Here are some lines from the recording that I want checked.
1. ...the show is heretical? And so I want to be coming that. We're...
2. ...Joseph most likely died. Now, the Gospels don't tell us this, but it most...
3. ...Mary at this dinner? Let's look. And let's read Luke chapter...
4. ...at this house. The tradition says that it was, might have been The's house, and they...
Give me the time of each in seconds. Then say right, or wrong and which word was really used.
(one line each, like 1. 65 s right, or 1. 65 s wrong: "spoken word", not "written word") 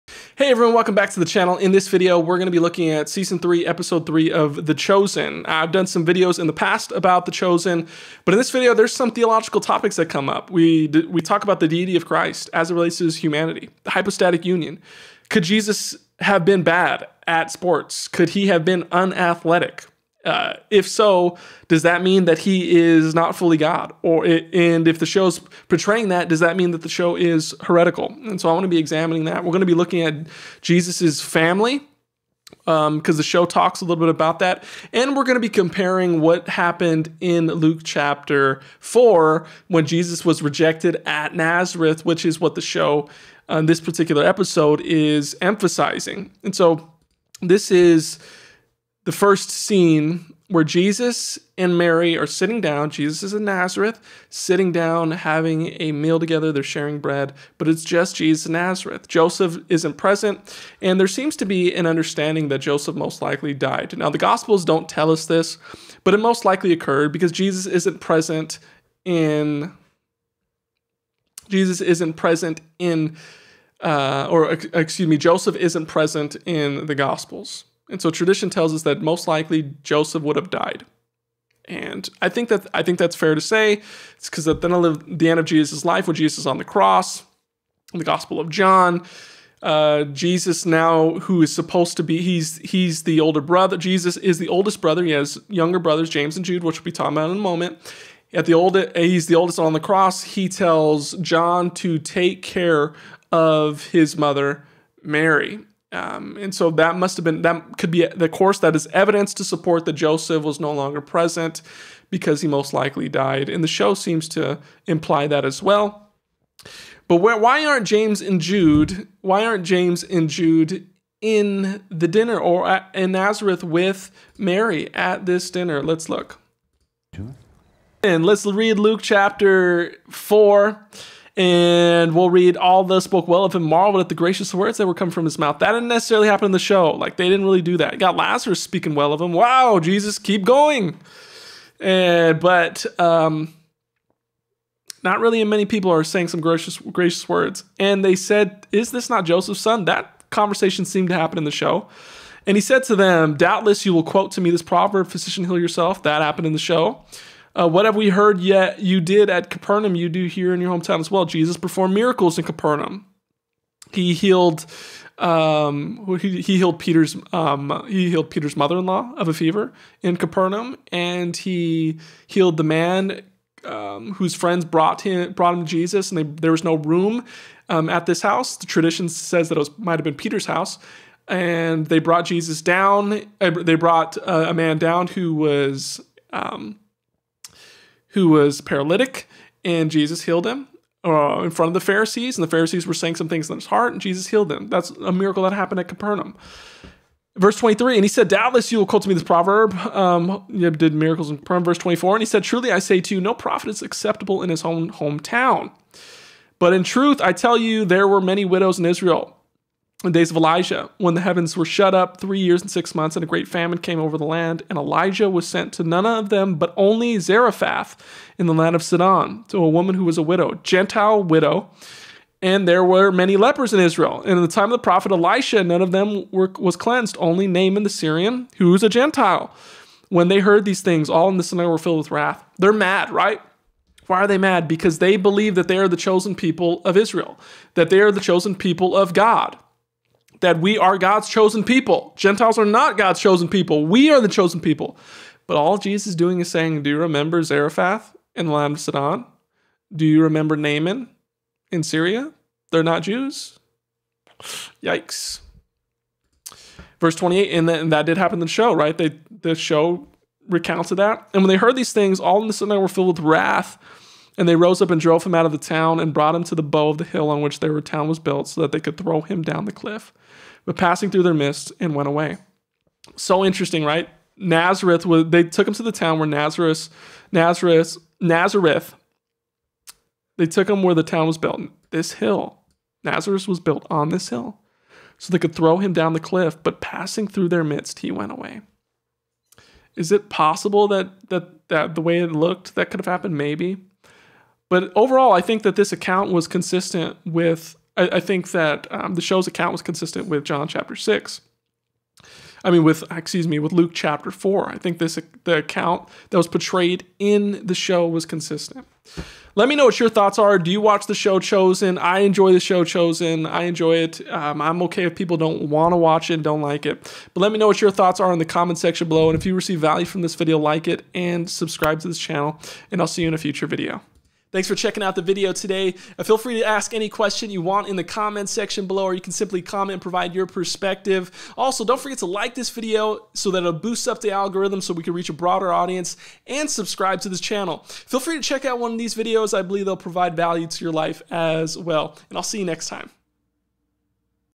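1. 26 s wrong: "examining", not "coming"
2. 62 s right
3. 124 s right
4. 177 s wrong: "Peter", not "The".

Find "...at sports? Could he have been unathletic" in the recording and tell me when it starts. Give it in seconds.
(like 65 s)
17 s.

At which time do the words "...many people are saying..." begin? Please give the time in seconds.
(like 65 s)
145 s.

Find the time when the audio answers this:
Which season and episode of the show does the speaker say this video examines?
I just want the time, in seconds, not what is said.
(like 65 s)
3 s.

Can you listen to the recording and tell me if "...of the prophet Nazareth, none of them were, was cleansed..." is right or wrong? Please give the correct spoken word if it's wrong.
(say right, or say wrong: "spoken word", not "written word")
wrong: "Elisha", not "Nazareth".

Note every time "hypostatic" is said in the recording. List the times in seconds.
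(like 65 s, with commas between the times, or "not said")
13 s.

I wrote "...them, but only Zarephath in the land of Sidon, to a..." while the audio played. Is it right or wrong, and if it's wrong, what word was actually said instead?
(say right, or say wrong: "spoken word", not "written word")
right.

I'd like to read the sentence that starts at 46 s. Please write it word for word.
And so this is the first scene where Jesus and Mary are sitting down.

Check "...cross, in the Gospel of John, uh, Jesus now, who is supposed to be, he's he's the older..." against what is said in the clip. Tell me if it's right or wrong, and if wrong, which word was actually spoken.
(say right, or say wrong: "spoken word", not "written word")
right.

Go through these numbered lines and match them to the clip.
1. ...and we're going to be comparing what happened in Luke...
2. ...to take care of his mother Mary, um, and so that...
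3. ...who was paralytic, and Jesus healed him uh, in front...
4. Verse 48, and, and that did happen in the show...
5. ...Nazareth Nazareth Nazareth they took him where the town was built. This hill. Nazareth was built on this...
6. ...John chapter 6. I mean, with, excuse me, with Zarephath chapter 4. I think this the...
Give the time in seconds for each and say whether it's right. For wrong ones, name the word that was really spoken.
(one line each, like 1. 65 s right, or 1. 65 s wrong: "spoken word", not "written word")
1. 34 s right
2. 101 s right
3. 188 s right
4. 256 s wrong: "28", not "48"
5. 276 s right
6. 300 s wrong: "Luke", not "Zarephath".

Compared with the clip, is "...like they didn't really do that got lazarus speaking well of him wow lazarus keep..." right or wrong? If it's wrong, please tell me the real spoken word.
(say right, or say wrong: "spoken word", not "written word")
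wrong: "jesus", not "lazarus".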